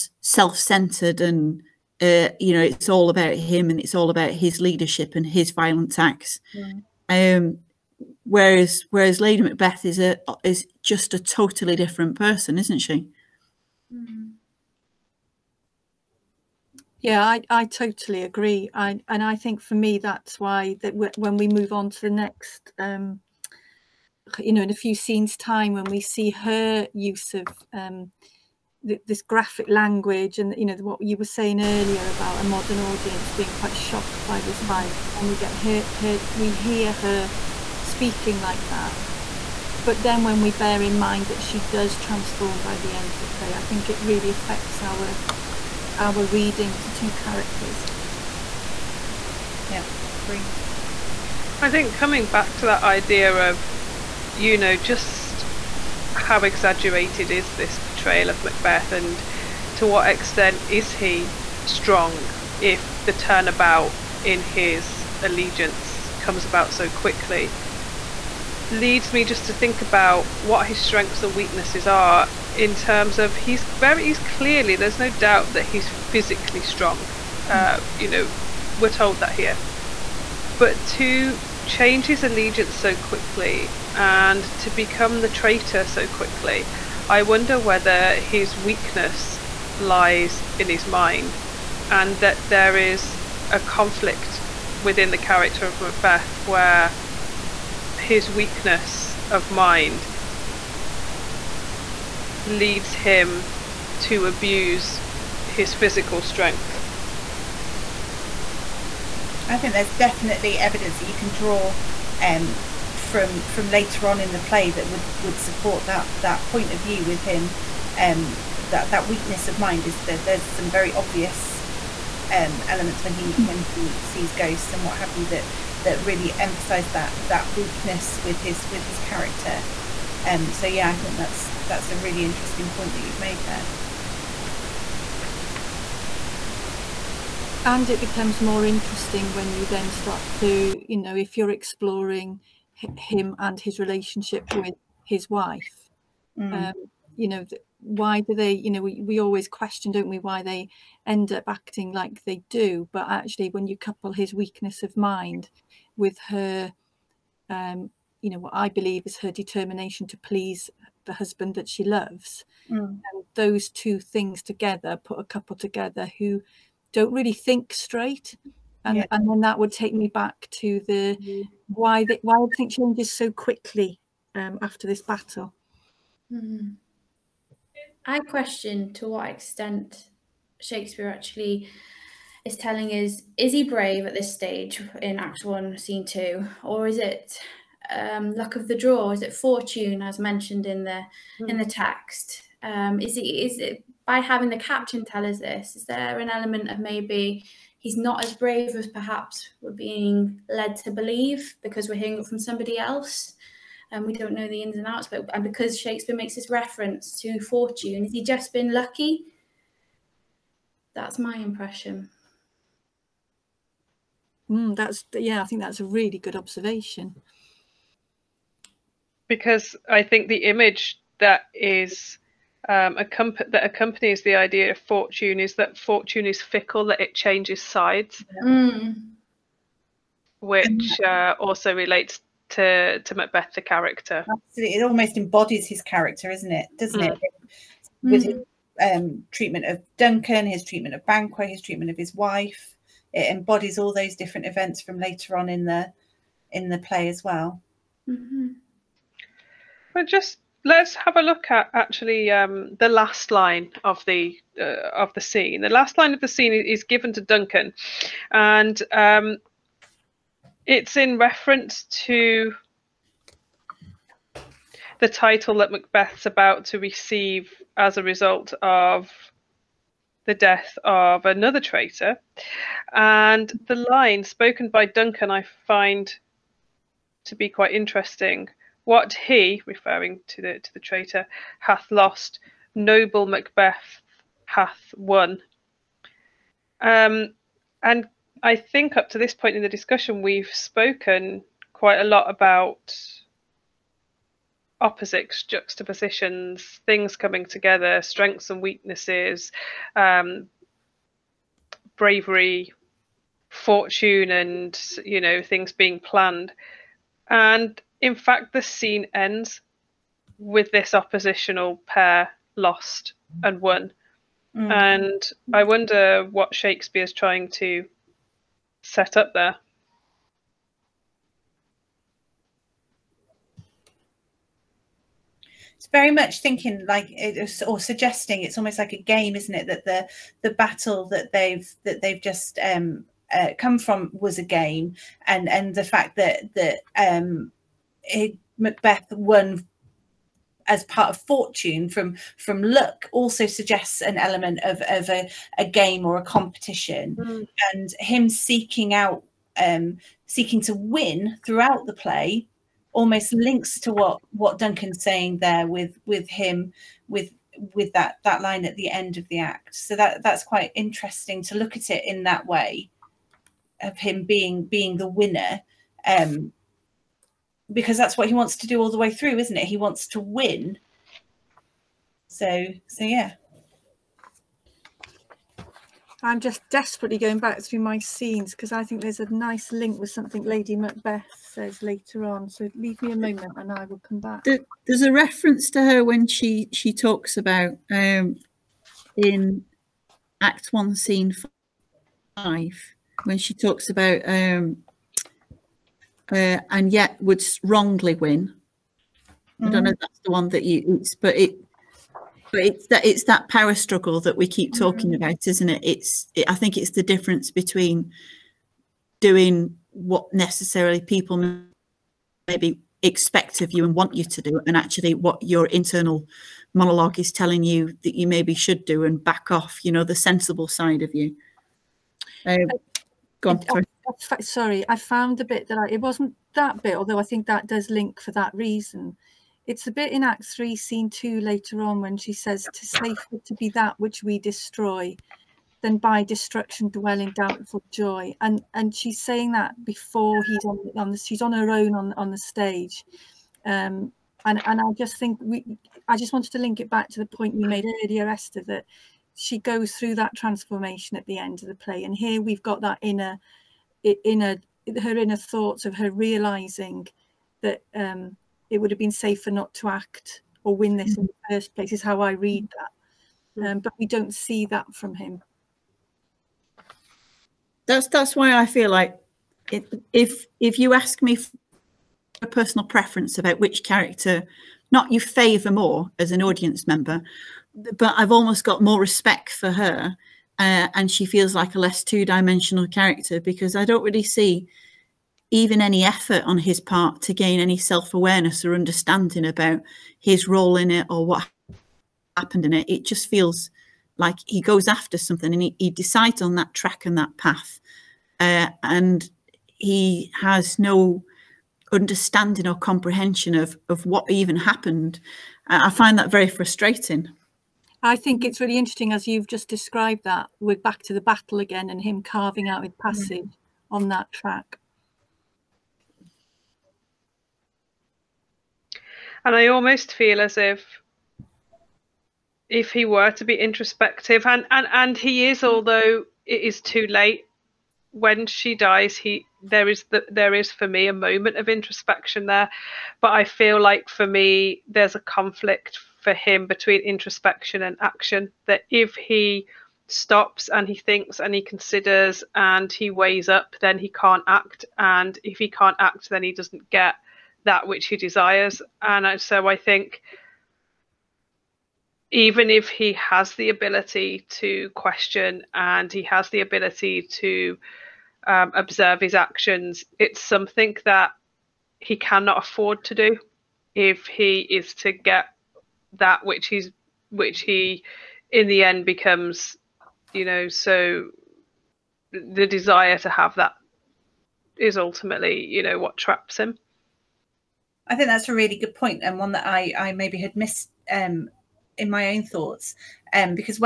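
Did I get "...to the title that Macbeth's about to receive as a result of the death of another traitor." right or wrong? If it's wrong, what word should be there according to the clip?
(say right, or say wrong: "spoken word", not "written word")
right.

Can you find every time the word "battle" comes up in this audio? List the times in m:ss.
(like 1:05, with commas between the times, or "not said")
2:55, 5:30, 8:31.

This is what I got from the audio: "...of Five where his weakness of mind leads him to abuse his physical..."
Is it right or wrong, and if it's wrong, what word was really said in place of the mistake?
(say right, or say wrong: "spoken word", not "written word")
wrong: "Macbeth", not "Five".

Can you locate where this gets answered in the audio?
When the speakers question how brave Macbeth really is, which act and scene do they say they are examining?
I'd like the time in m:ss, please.
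3:05.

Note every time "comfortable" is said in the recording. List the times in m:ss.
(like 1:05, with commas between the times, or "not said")
not said.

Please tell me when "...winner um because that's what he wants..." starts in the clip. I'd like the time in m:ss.
6:05.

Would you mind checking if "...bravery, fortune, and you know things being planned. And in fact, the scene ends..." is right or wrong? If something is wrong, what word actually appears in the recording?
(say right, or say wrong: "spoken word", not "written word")
right.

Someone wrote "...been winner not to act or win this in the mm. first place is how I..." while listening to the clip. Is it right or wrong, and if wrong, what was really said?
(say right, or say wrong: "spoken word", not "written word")
wrong: "safer", not "winner".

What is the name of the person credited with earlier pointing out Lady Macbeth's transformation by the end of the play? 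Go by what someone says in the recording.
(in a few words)
Esther.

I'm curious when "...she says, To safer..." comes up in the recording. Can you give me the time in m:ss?
7:12.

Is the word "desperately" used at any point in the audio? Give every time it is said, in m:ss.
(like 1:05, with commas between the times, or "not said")
6:16.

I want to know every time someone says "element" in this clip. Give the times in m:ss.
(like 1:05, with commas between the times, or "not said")
2:02, 3:16, 5:44.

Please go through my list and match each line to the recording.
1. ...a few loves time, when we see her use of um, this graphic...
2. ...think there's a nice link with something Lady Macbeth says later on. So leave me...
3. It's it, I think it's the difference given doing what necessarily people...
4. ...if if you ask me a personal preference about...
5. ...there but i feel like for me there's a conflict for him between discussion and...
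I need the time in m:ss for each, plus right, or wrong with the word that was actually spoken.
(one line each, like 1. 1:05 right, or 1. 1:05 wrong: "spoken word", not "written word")
1. 0:24 wrong: "scenes", not "loves"
2. 6:18 right
3. 6:45 wrong: "between", not "given"
4. 7:50 right
5. 8:52 wrong: "introspection", not "discussion".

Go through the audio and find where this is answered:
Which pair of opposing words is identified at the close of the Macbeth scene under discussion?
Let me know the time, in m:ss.
5:12.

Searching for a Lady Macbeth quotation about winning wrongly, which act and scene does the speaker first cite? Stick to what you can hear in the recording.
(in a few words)
Act One, Scene Five.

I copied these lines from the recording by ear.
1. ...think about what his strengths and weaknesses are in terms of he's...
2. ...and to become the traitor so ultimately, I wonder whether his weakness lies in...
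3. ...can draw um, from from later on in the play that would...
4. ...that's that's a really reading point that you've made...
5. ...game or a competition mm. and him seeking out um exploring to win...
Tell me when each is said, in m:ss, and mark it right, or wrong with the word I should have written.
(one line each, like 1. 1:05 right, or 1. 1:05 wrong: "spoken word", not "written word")
1. 1:09 right
2. 1:23 wrong: "quickly", not "ultimately"
3. 1:51 right
4. 2:11 wrong: "interesting", not "reading"
5. 5:45 wrong: "seeking", not "exploring".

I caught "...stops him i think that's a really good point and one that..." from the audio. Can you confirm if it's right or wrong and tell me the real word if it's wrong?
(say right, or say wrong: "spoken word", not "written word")
wrong: "traps", not "stops".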